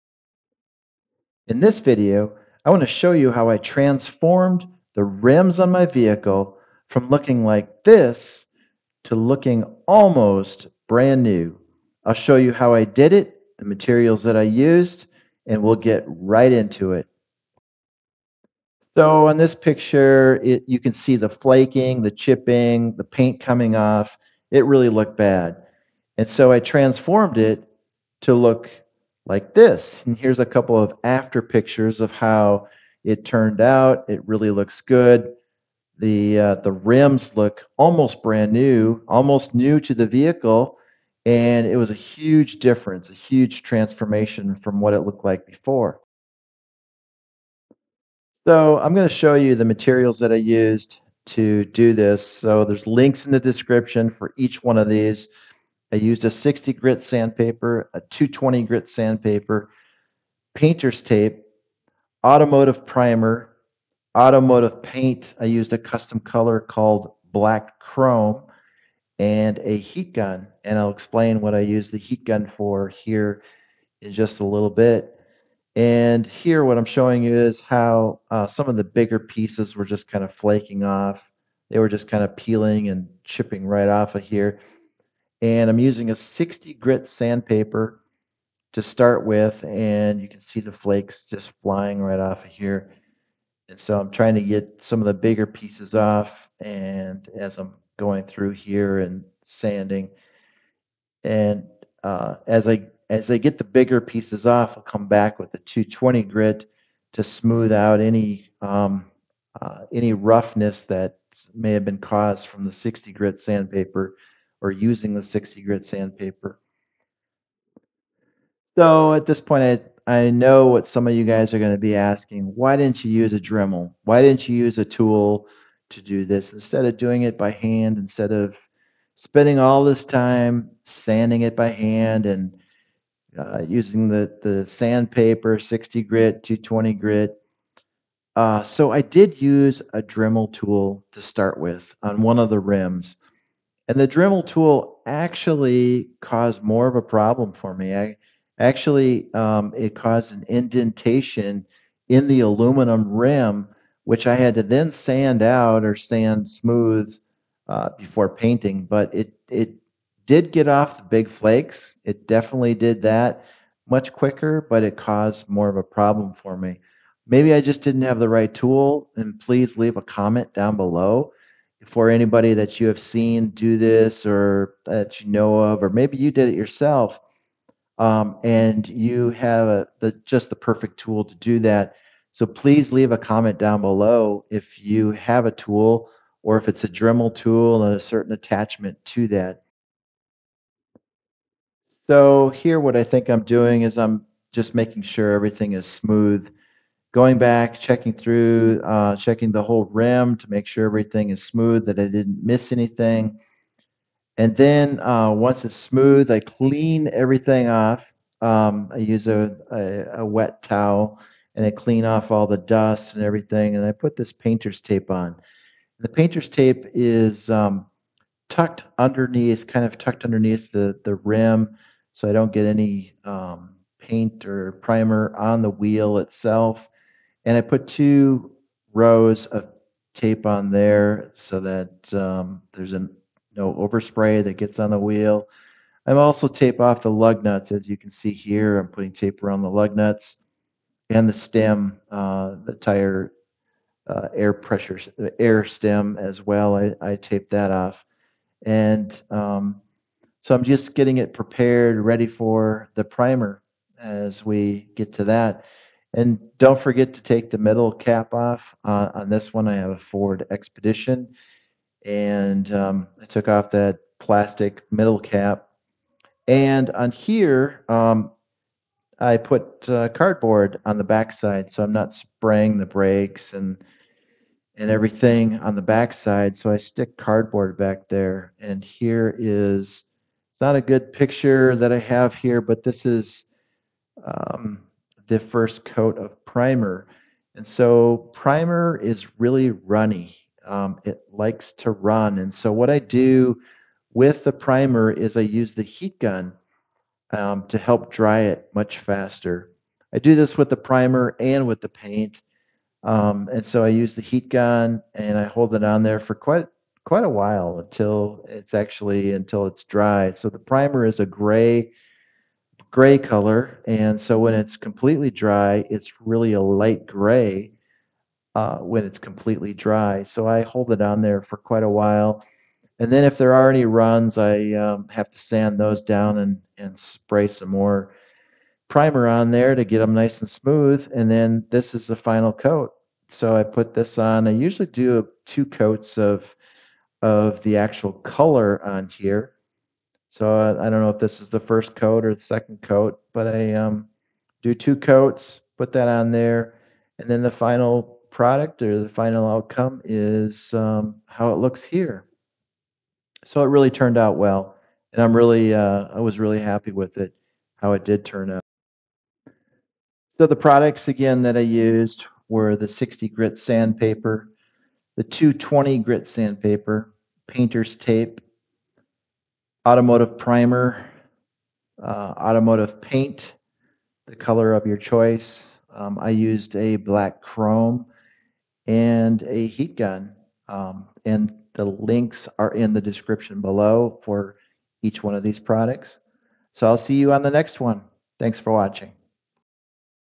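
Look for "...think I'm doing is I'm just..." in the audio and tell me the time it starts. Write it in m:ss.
3:13.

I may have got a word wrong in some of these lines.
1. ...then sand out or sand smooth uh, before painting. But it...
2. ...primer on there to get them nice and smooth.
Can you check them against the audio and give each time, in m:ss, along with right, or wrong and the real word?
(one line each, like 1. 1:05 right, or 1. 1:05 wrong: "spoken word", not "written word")
1. 2:34 right
2. 5:28 right.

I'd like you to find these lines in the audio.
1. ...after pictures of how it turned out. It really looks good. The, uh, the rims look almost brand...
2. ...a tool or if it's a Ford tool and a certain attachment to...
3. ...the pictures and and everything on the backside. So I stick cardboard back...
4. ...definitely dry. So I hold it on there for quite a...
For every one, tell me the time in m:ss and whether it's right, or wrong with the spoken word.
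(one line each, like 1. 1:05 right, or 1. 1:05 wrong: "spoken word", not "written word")
1. 0:31 right
2. 3:05 wrong: "Dremel", not "Ford"
3. 4:32 wrong: "brakes", not "pictures"
4. 5:19 wrong: "completely", not "definitely".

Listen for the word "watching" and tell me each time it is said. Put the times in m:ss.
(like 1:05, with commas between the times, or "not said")
6:28.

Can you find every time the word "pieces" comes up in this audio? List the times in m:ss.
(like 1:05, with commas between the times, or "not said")
1:19, 1:35, 1:43.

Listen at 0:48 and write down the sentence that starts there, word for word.
So I'm going to show you the materials that I used to do this.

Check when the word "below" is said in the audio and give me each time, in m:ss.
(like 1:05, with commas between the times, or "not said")
2:50, 3:03, 6:23.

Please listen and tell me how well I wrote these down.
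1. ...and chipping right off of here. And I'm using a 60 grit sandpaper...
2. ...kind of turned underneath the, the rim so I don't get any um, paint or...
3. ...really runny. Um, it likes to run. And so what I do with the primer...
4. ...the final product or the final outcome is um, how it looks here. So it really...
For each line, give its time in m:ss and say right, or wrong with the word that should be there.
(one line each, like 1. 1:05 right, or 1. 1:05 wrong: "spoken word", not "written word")
1. 1:22 right
2. 3:39 wrong: "tucked", not "turned"
3. 4:49 right
4. 5:47 right.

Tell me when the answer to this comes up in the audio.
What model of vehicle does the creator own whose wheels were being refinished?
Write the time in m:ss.
4:19.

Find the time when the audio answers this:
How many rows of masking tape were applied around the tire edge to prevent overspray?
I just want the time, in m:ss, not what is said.
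3:47.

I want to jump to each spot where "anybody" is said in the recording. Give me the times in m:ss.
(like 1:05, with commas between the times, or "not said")
2:52.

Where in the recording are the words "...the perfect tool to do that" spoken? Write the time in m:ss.
3:00.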